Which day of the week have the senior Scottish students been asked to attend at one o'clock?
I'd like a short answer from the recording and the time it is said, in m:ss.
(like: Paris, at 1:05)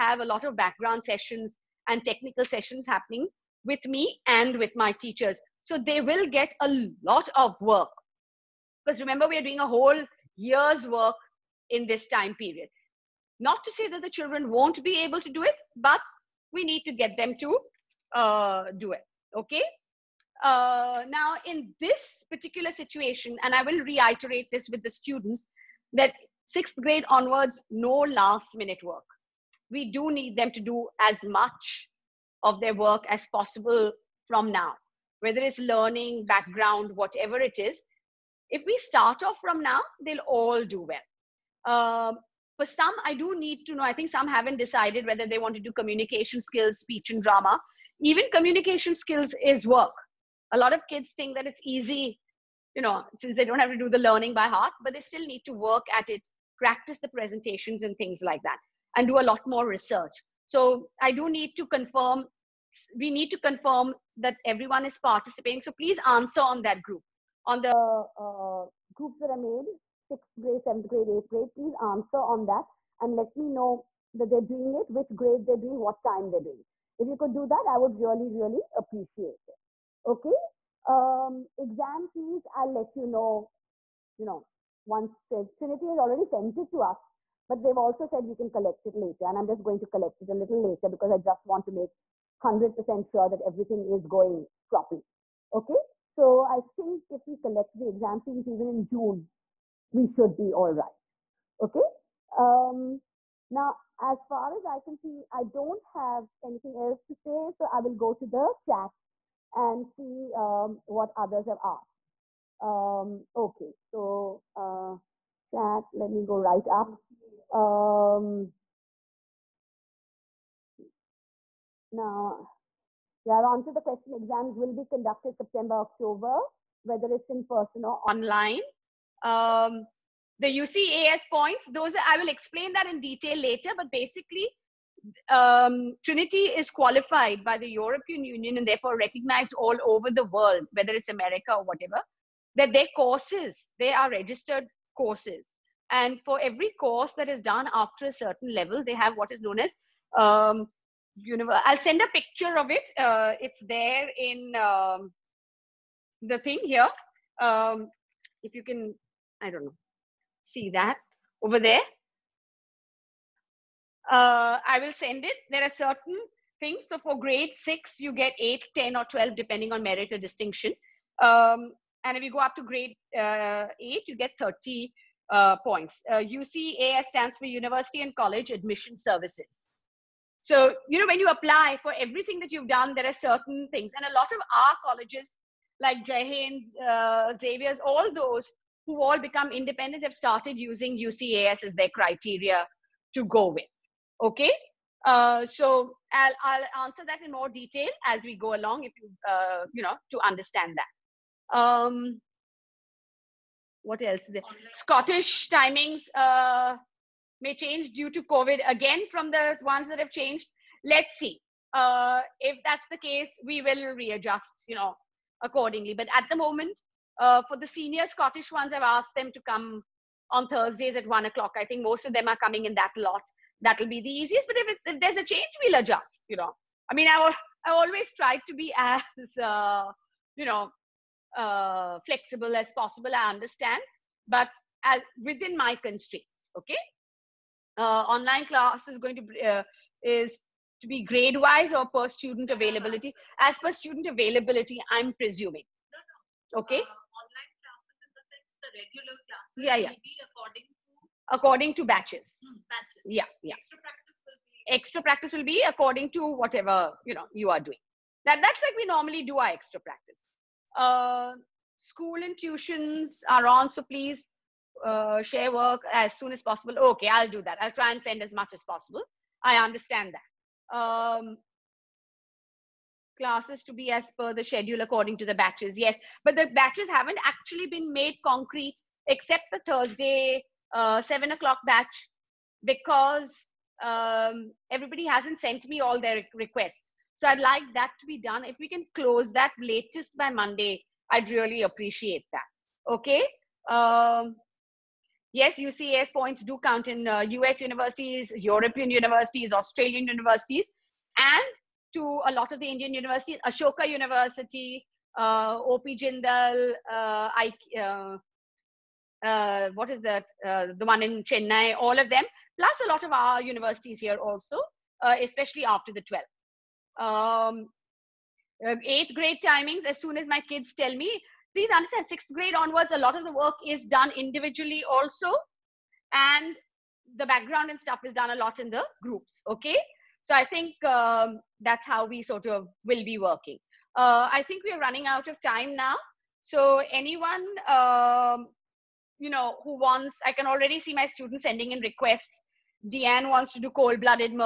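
Thursdays, at 3:40.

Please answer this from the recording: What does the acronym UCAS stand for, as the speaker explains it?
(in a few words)
University and College Admission Services.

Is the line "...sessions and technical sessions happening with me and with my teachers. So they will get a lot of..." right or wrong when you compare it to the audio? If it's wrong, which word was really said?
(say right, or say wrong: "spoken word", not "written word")
right.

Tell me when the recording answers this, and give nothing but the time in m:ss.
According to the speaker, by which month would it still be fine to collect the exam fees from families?
1:38.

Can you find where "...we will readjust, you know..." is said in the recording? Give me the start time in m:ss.
3:33.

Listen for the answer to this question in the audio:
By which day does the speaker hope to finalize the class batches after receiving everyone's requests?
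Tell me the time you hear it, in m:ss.
4:50.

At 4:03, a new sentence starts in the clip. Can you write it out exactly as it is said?
As per student availability, I'm presuming.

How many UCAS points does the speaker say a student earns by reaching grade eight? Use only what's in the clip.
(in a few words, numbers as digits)
30.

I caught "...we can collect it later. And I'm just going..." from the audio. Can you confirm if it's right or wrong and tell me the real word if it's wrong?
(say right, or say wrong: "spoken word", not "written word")
right.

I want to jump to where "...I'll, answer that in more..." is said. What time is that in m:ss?
3:16.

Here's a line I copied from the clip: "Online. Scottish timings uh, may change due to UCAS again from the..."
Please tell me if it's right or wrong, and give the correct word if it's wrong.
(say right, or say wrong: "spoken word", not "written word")
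wrong: "COVID", not "UCAS".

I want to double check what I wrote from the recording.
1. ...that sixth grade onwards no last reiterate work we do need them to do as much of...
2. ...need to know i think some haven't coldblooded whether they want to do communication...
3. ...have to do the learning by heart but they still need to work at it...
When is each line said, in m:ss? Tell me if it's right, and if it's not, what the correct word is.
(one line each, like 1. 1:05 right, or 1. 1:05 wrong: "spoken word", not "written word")
1. 0:25 wrong: "minute", not "reiterate"
2. 0:43 wrong: "decided", not "coldblooded"
3. 0:53 right.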